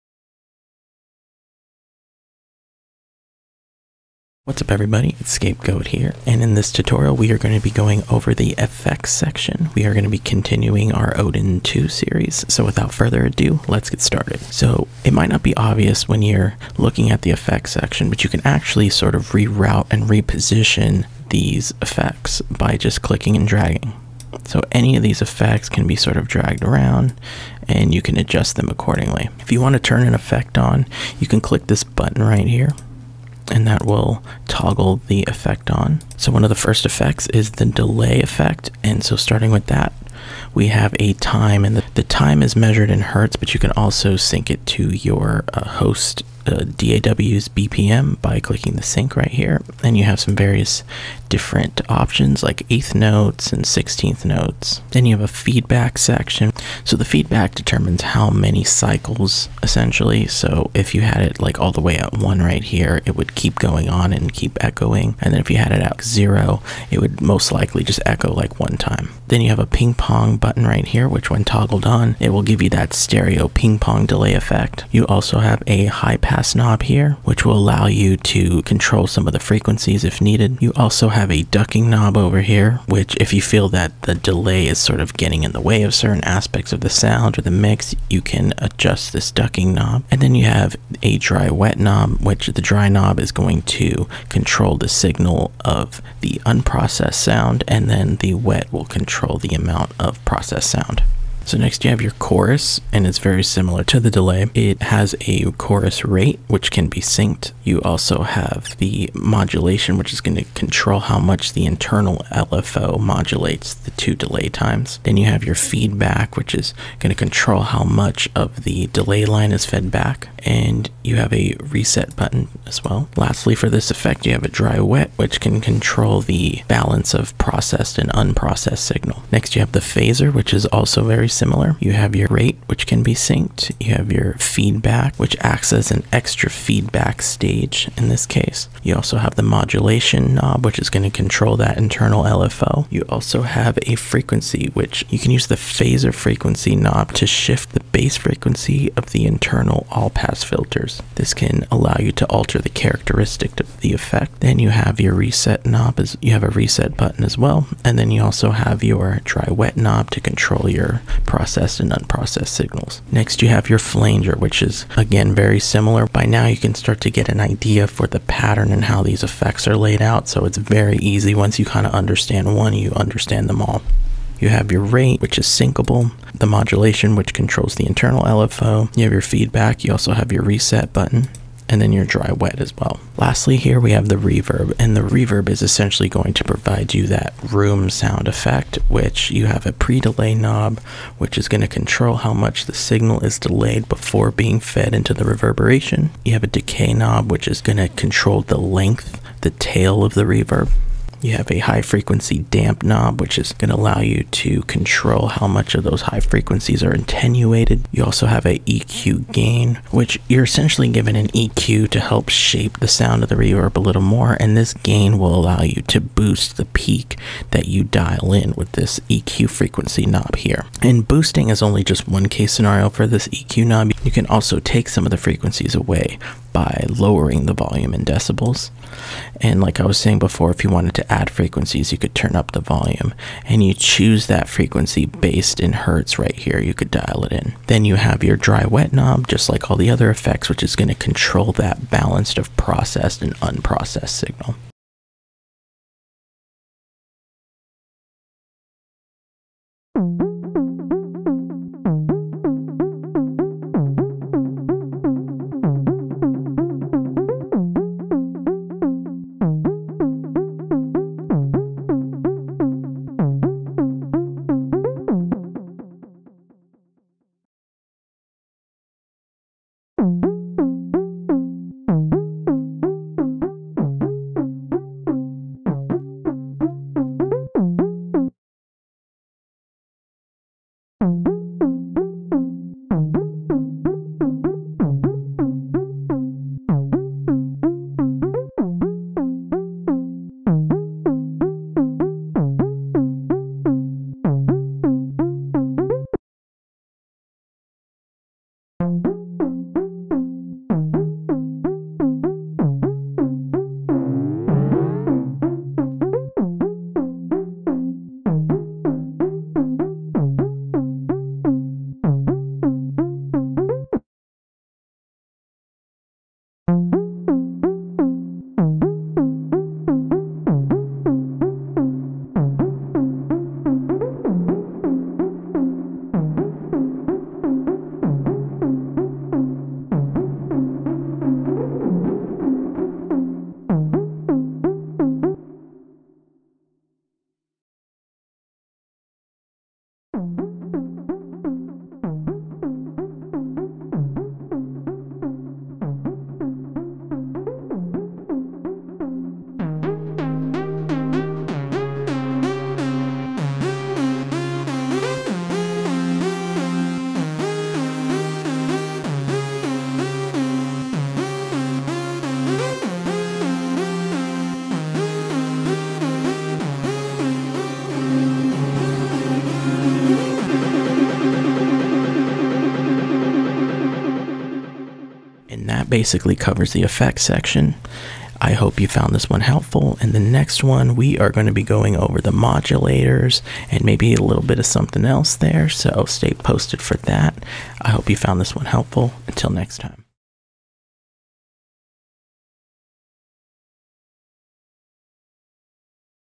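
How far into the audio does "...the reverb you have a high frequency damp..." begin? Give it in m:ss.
3:20.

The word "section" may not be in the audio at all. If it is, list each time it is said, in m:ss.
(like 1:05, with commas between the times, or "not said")
0:09, 0:17, 0:55, 6:17.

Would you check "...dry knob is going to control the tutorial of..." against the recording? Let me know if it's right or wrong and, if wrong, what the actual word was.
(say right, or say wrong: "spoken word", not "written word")
wrong: "signal", not "tutorial".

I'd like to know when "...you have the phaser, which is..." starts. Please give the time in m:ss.
2:09.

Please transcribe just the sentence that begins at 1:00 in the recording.
So if you had it like all the way at one right here, it would keep going on and keep echoing.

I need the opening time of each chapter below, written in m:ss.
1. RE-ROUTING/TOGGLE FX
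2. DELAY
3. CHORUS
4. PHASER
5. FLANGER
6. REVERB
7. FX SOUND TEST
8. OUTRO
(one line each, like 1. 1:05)
1. 0:15
2. 0:37
3. 1:41
4. 2:09
5. 2:43
6. 3:03
7. 4:05
8. 6:15.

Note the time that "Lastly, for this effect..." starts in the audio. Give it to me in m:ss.
2:03.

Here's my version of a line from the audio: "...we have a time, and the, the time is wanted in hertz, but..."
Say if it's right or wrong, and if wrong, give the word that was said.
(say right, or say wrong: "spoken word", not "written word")
wrong: "measured", not "wanted".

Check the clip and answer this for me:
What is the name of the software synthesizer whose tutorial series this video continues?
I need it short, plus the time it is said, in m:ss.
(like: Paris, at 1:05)
Odin 2, at 0:11.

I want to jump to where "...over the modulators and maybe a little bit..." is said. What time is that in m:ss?
6:21.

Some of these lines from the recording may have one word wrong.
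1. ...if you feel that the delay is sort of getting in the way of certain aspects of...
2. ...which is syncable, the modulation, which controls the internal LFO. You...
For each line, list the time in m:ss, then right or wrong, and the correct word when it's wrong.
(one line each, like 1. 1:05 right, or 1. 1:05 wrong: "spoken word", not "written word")
1. 1:23 right
2. 2:55 right.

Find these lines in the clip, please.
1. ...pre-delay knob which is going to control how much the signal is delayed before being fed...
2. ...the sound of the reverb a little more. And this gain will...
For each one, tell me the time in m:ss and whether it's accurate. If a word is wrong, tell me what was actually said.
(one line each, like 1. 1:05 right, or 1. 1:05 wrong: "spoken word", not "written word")
1. 3:09 right
2. 3:32 right.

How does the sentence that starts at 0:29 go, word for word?
If you want to turn an effect on, you can click this button right here and that will toggle the effect on.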